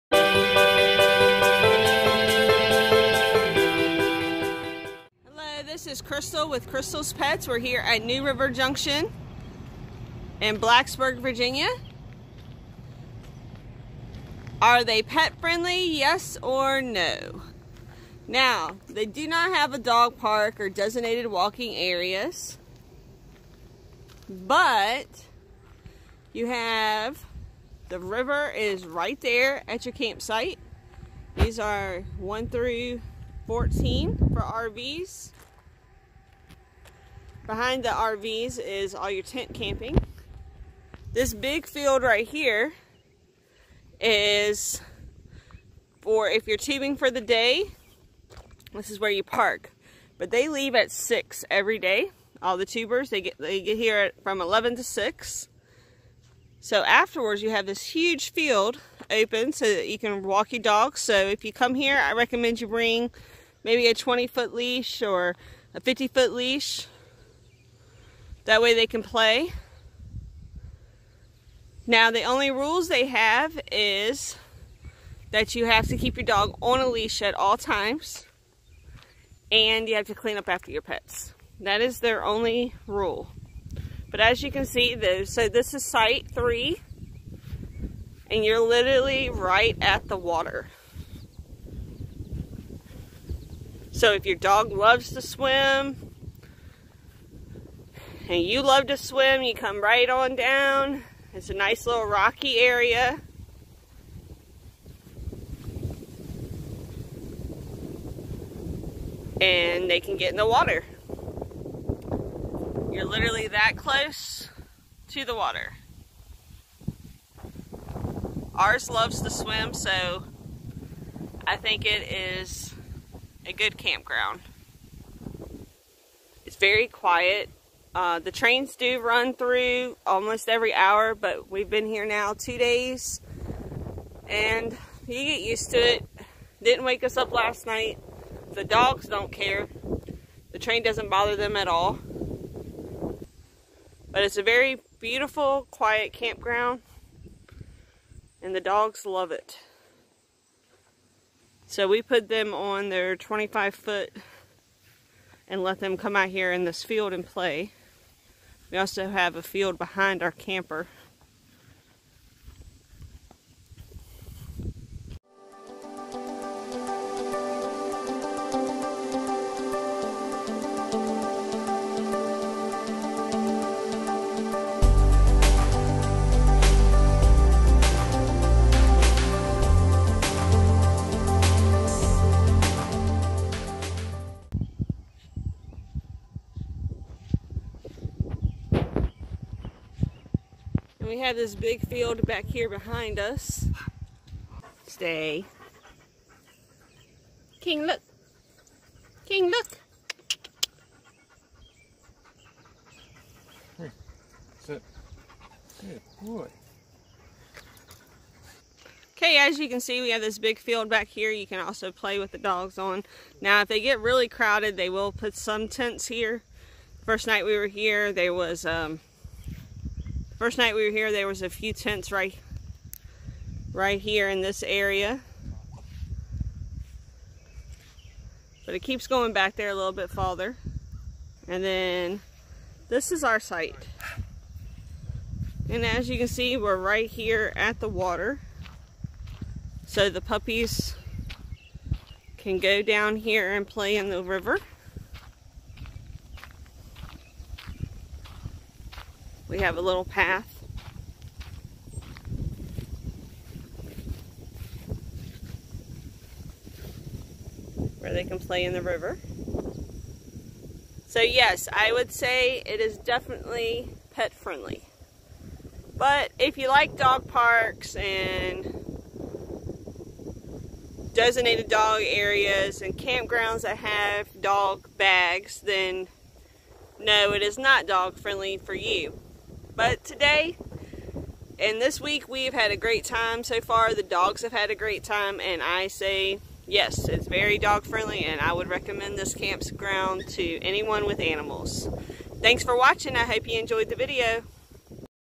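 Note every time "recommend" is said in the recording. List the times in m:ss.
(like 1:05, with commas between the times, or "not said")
1:02, 4:48.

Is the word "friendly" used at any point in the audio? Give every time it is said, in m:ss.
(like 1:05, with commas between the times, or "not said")
0:15, 4:24, 4:38, 4:47.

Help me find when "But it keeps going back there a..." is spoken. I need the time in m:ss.
3:48.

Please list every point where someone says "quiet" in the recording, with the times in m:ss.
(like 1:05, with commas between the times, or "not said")
2:06, 2:25.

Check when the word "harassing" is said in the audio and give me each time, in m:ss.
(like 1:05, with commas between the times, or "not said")
not said.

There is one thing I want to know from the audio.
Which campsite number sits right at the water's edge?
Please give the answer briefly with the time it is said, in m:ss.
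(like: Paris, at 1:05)
3, at 1:26.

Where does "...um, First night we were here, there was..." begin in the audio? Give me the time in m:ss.
3:38.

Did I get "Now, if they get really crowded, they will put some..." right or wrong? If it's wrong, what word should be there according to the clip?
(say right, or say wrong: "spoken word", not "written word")
right.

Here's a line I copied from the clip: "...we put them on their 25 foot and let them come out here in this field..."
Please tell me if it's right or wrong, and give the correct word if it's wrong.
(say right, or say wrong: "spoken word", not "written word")
right.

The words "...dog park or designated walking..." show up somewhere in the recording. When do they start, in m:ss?
0:19.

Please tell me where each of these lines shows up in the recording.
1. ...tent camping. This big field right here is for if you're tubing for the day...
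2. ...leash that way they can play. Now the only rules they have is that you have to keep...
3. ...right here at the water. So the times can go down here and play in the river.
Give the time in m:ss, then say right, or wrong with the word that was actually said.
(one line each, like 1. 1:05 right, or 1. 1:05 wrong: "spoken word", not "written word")
1. 0:39 right
2. 1:06 right
3. 3:56 wrong: "puppies", not "times".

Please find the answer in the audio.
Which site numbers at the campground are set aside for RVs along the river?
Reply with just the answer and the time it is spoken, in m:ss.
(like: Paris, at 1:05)
1 through 14, at 0:32.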